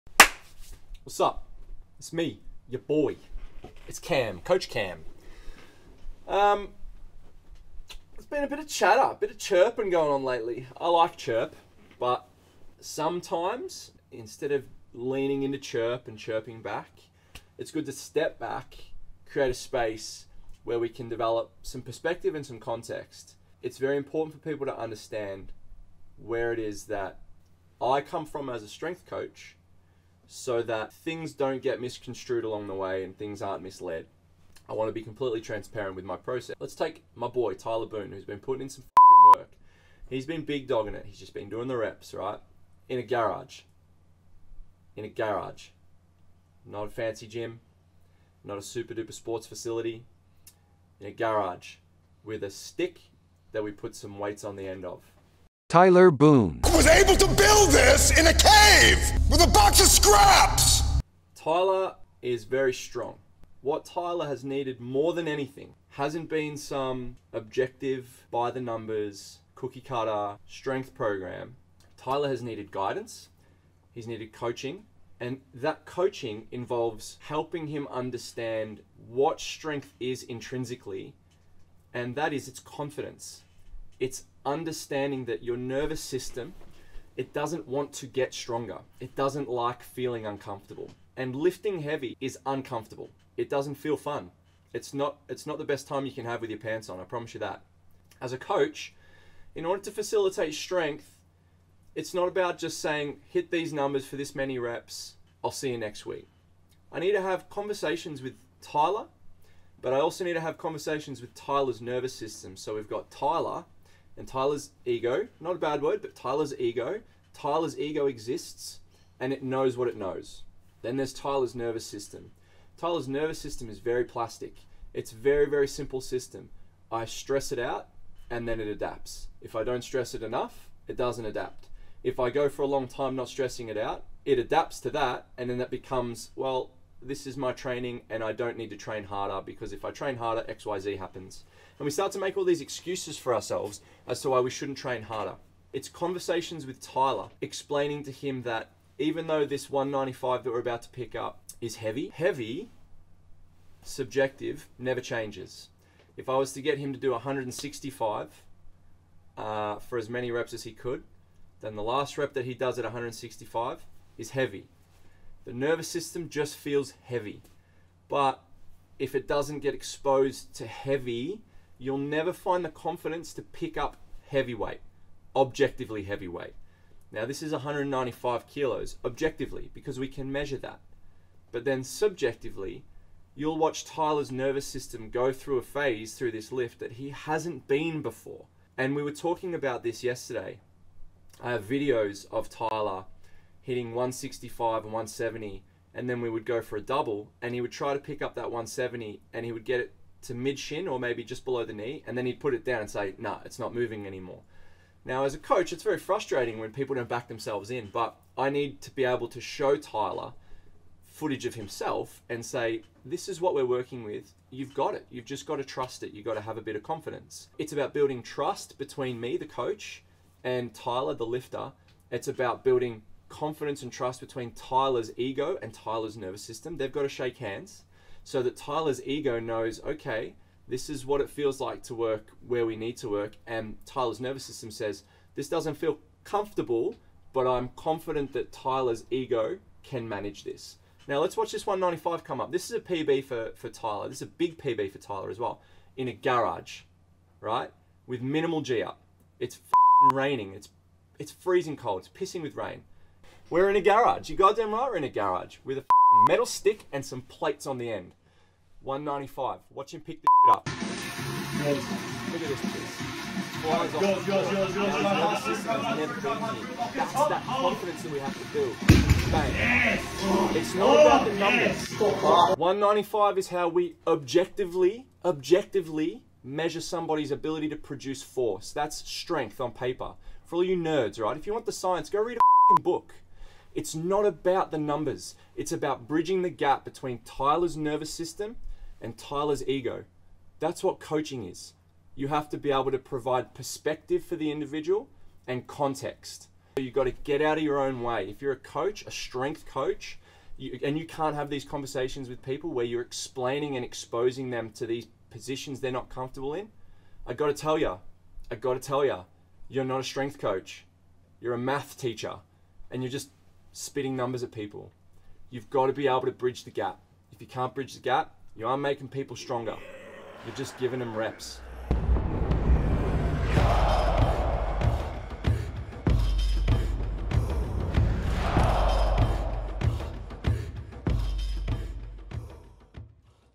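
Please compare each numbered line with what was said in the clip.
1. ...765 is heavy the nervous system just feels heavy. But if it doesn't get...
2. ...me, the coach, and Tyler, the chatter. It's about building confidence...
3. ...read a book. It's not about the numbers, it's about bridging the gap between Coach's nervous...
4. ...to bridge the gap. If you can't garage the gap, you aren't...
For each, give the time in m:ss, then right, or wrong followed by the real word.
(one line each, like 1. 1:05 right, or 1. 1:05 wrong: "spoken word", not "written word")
1. 2:42 wrong: "165", not "765"
2. 3:39 wrong: "lifter", not "chatter"
3. 4:42 wrong: "Tyler", not "Coach"
4. 5:16 wrong: "bridge", not "garage".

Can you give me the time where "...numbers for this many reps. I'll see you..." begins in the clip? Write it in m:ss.
1:43.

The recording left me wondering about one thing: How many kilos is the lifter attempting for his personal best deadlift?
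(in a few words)
195 kilos.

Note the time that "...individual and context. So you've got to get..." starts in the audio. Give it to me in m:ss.
4:54.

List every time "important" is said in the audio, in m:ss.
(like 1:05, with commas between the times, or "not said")
0:23.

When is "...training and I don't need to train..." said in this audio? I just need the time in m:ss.
2:17.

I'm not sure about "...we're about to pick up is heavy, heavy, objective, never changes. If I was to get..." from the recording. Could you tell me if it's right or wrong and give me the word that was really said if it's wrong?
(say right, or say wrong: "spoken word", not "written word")
wrong: "subjective", not "objective".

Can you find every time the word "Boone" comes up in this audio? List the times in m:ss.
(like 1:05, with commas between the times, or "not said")
0:37, 0:56.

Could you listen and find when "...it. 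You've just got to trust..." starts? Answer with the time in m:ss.
3:34.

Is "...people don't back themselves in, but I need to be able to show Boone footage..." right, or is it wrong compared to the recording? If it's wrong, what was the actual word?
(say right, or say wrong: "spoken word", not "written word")
wrong: "Tyler", not "Boone".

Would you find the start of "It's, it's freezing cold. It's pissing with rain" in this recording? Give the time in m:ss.
4:10.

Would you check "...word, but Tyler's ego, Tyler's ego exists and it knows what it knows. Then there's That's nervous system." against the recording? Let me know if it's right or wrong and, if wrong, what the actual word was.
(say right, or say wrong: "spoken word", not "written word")
wrong: "Tyler", not "That".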